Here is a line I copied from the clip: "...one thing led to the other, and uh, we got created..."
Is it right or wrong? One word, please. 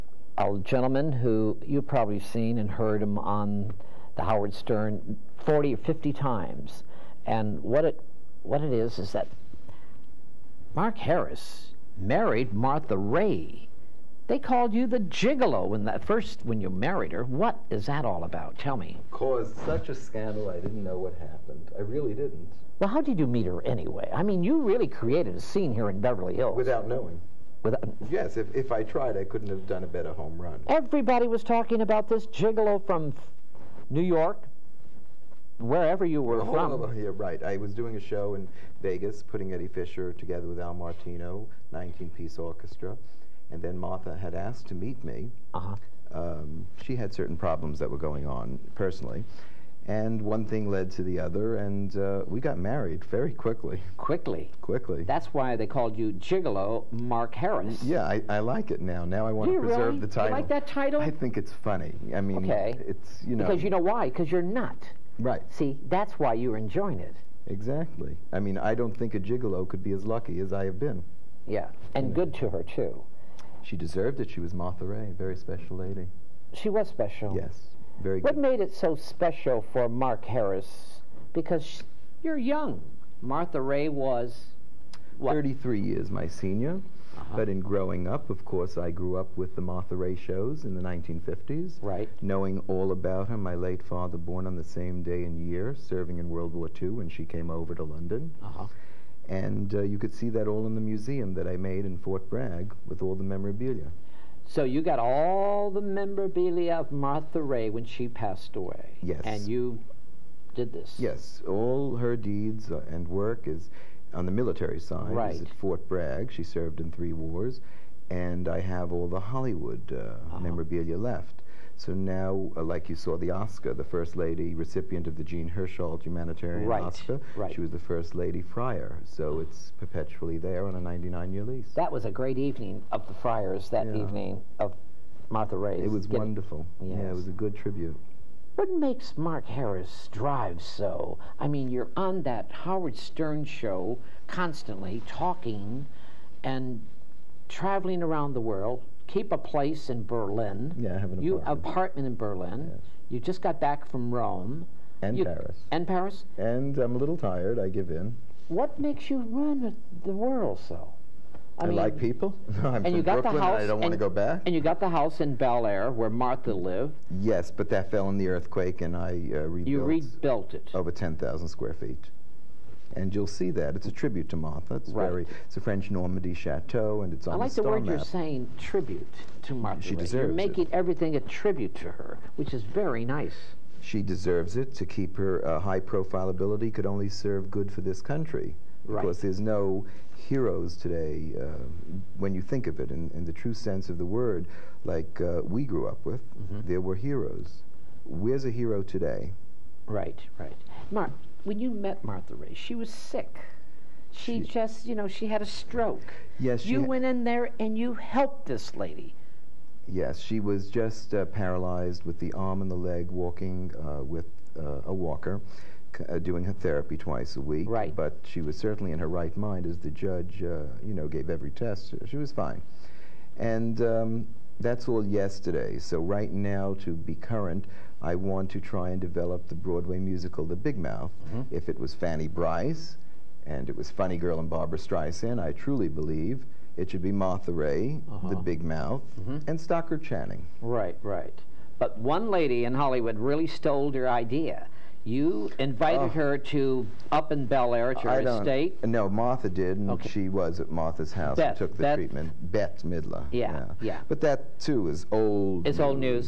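wrong.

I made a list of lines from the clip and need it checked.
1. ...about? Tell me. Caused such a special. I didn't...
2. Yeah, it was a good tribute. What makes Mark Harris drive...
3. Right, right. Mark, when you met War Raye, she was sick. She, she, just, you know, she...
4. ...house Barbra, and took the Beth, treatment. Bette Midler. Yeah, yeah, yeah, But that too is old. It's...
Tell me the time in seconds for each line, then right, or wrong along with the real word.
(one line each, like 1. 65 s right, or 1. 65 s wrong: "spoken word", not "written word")
1. 18 s wrong: "scandal", not "special"
2. 136 s right
3. 199 s wrong: "Martha", not "War"
4. 251 s wrong: "Beth", not "Barbra".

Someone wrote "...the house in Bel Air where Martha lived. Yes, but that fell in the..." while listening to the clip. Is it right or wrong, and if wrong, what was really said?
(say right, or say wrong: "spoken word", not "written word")
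right.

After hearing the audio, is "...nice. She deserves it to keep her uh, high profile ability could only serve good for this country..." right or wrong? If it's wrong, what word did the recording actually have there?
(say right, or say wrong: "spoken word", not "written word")
right.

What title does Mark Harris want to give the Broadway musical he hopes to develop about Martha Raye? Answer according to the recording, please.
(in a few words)
The Big Mouth.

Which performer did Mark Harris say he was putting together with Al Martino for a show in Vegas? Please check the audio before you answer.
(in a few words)
Eddie Fisher.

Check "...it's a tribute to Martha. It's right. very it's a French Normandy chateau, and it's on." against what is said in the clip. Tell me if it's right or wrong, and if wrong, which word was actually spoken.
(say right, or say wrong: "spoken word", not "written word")
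right.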